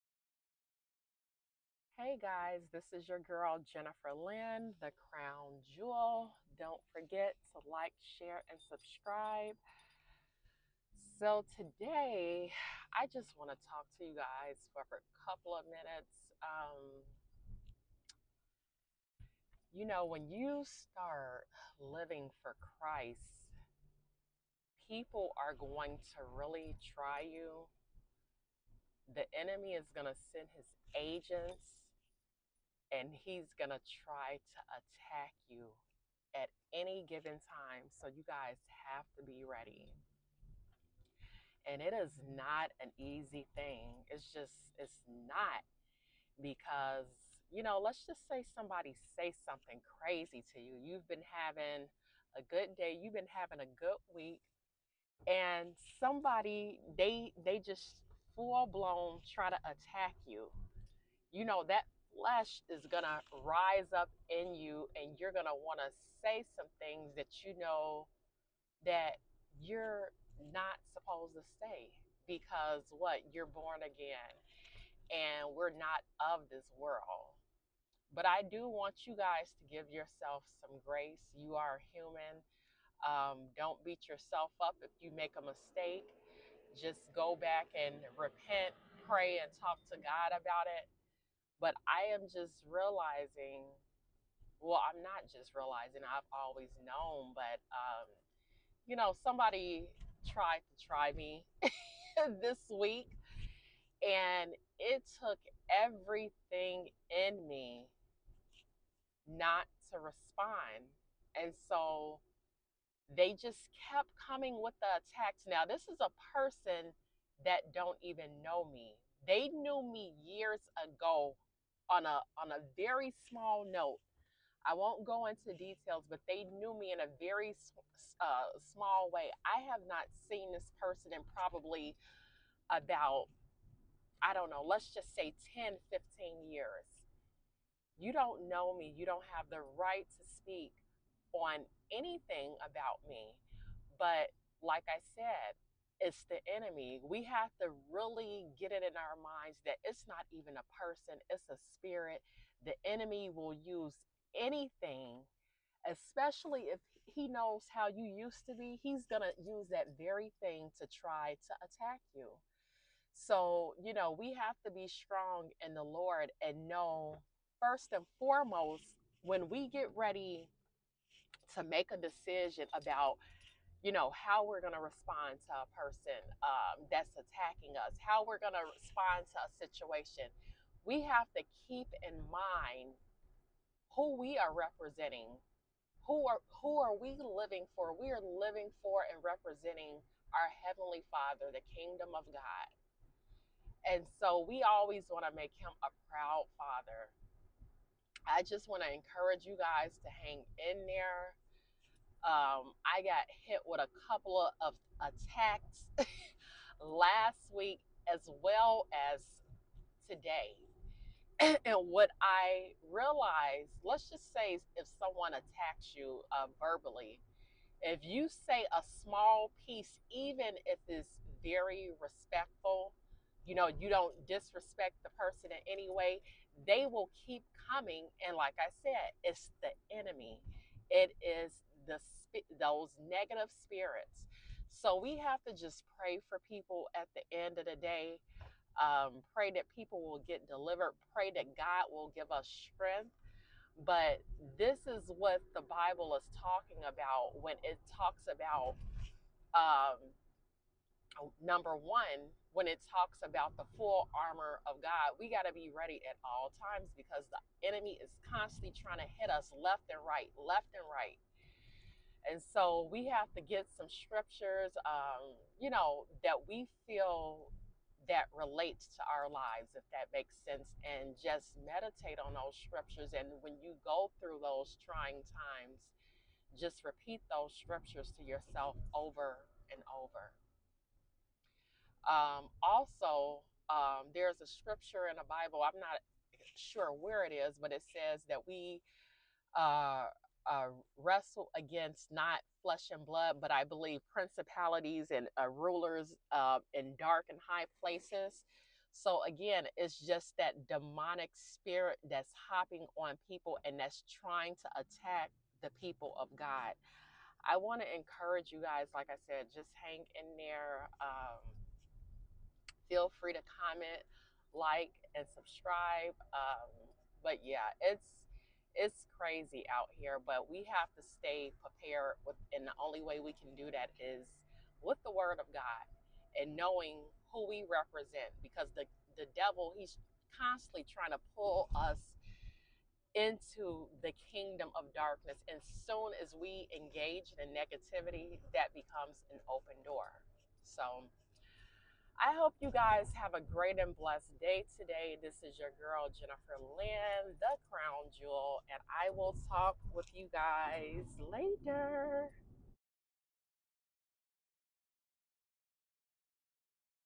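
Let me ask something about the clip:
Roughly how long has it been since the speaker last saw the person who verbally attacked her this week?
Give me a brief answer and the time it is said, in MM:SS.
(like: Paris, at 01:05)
10 to 15 years, at 02:15.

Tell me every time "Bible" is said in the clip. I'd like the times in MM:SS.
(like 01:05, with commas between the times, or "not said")
04:05, 04:45.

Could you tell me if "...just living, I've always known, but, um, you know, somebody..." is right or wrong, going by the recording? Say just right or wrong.
wrong.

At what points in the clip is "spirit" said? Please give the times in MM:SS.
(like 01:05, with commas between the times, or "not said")
02:31, 03:53, 05:01.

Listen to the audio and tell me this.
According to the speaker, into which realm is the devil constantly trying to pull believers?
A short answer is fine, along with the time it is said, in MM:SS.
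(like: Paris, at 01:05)
kingdom of darkness, at 05:34.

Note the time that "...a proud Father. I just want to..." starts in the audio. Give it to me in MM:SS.
03:15.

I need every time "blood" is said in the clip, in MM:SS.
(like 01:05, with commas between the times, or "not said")
04:53.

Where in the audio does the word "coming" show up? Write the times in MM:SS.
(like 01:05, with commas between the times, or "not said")
01:54, 03:47.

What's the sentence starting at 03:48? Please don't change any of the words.
And like I said, it's the enemy.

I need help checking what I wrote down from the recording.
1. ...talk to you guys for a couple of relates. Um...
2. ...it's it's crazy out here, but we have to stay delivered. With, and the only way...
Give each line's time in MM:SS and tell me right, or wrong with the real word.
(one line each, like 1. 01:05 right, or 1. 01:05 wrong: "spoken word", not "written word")
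1. 00:13 wrong: "minutes", not "relates"
2. 05:17 wrong: "prepared", not "delivered".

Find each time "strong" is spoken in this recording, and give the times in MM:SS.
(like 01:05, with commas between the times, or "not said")
02:44.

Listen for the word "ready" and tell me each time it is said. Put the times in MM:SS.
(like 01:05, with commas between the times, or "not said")
00:39, 02:49, 04:15.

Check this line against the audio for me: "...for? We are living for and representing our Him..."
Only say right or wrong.
wrong.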